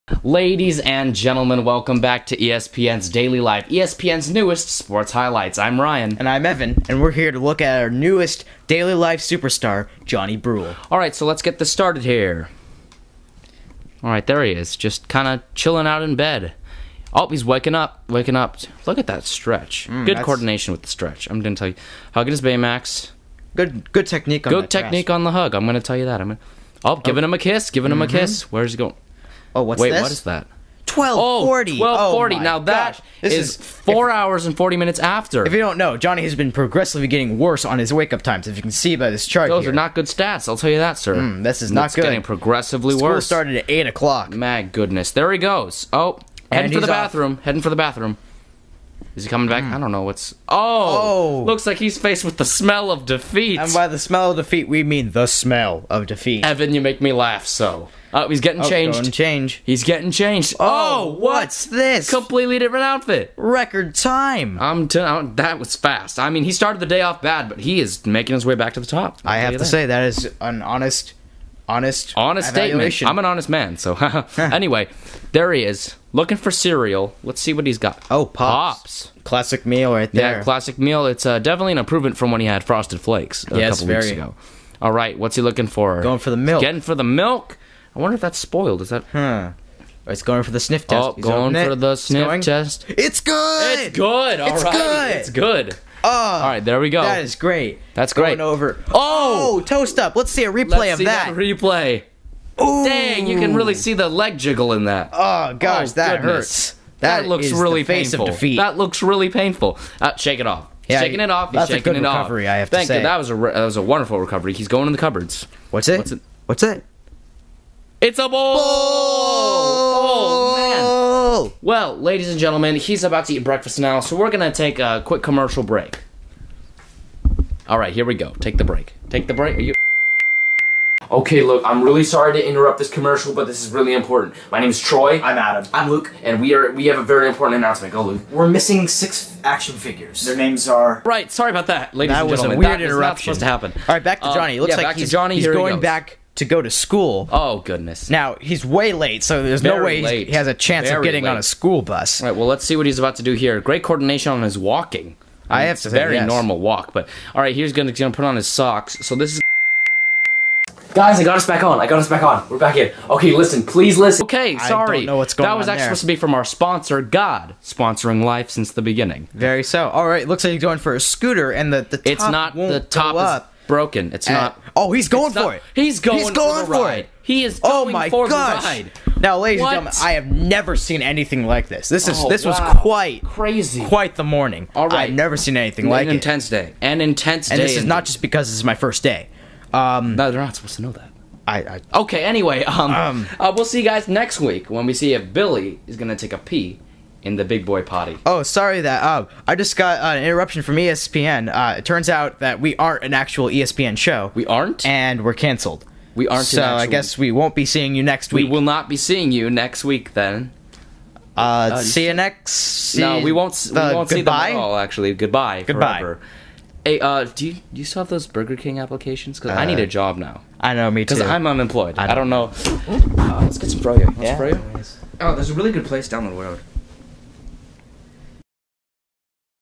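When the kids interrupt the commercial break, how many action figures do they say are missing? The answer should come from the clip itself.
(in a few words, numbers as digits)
6.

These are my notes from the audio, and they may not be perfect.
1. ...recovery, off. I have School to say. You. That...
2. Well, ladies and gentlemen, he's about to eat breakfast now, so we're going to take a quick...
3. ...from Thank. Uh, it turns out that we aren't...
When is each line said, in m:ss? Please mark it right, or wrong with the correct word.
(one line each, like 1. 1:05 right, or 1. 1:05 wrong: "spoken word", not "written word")
1. 1:51 wrong: "Thank", not "School"
2. 2:01 right
3. 3:20 wrong: "ESPN", not "Thank".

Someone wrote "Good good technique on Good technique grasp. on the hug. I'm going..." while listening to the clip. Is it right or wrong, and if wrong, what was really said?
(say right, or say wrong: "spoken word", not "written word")
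right.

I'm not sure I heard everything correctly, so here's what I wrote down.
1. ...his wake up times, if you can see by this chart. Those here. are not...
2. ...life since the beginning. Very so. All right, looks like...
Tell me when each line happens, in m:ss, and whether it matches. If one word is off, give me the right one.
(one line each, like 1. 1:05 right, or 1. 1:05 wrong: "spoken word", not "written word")
1. 0:37 right
2. 2:48 right.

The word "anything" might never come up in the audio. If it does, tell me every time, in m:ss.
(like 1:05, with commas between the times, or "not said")
3:01, 3:05.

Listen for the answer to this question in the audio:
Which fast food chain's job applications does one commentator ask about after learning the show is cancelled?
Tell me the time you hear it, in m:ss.
3:38.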